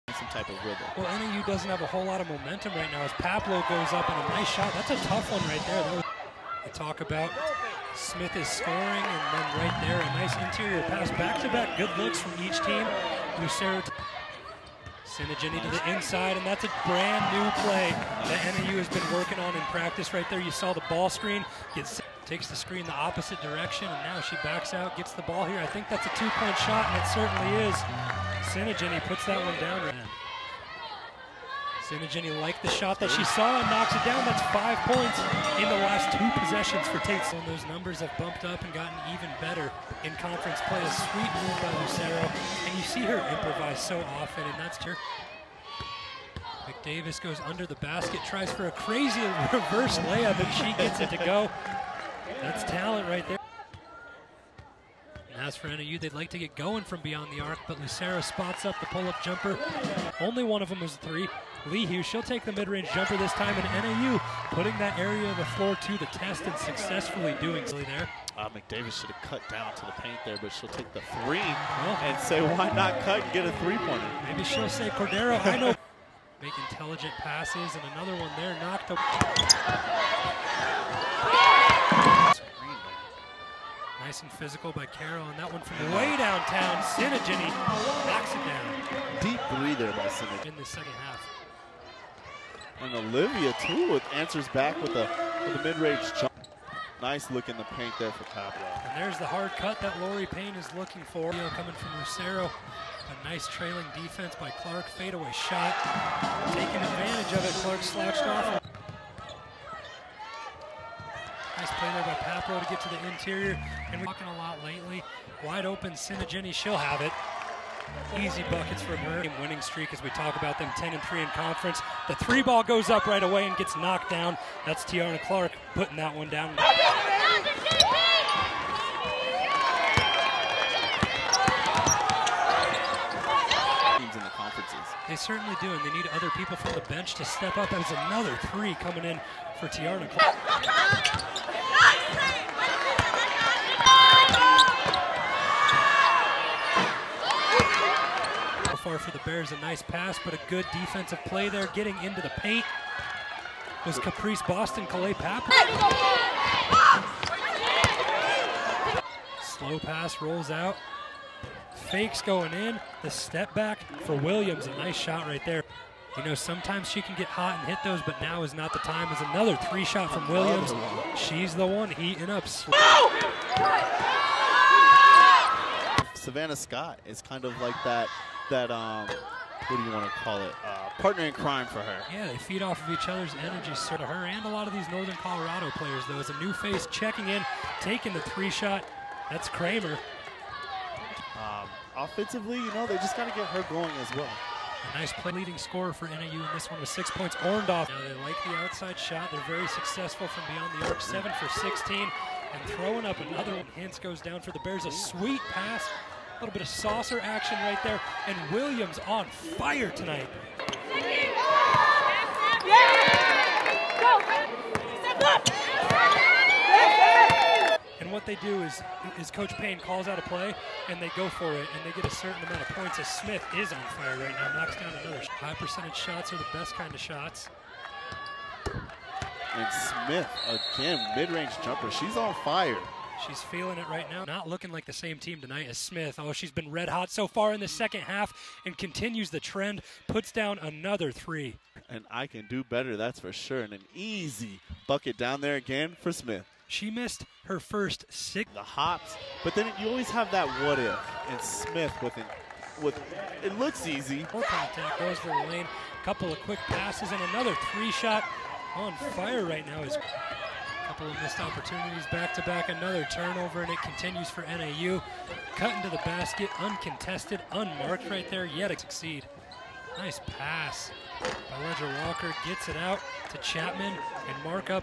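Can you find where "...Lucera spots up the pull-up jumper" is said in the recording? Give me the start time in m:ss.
0:57.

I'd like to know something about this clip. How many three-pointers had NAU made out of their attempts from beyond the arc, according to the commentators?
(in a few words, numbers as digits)
7 for 16.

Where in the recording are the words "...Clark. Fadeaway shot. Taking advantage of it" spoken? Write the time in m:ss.
1:44.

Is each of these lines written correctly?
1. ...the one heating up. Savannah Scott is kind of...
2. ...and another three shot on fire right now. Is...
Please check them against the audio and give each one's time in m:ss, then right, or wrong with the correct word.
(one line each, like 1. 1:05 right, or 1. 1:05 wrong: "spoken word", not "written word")
1. 2:51 right
2. 4:17 right.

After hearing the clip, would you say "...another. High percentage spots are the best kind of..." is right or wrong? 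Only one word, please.
wrong.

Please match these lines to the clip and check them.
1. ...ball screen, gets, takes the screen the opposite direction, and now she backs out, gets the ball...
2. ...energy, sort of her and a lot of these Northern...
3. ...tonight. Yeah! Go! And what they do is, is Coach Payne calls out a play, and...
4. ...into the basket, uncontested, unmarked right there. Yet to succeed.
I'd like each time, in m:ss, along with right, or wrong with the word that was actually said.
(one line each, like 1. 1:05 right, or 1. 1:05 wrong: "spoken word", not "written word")
1. 0:20 right
2. 3:03 right
3. 3:29 right
4. 4:25 right.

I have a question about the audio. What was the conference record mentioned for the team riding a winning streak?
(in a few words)
10 and 3.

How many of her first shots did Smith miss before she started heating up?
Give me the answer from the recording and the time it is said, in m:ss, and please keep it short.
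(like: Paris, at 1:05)
6, at 4:07.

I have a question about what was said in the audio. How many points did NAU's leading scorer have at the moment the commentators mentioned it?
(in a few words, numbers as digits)
6.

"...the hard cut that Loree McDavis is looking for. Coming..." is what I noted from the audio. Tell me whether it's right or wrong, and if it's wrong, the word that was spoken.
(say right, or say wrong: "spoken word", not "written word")
wrong: "Payne", not "McDavis".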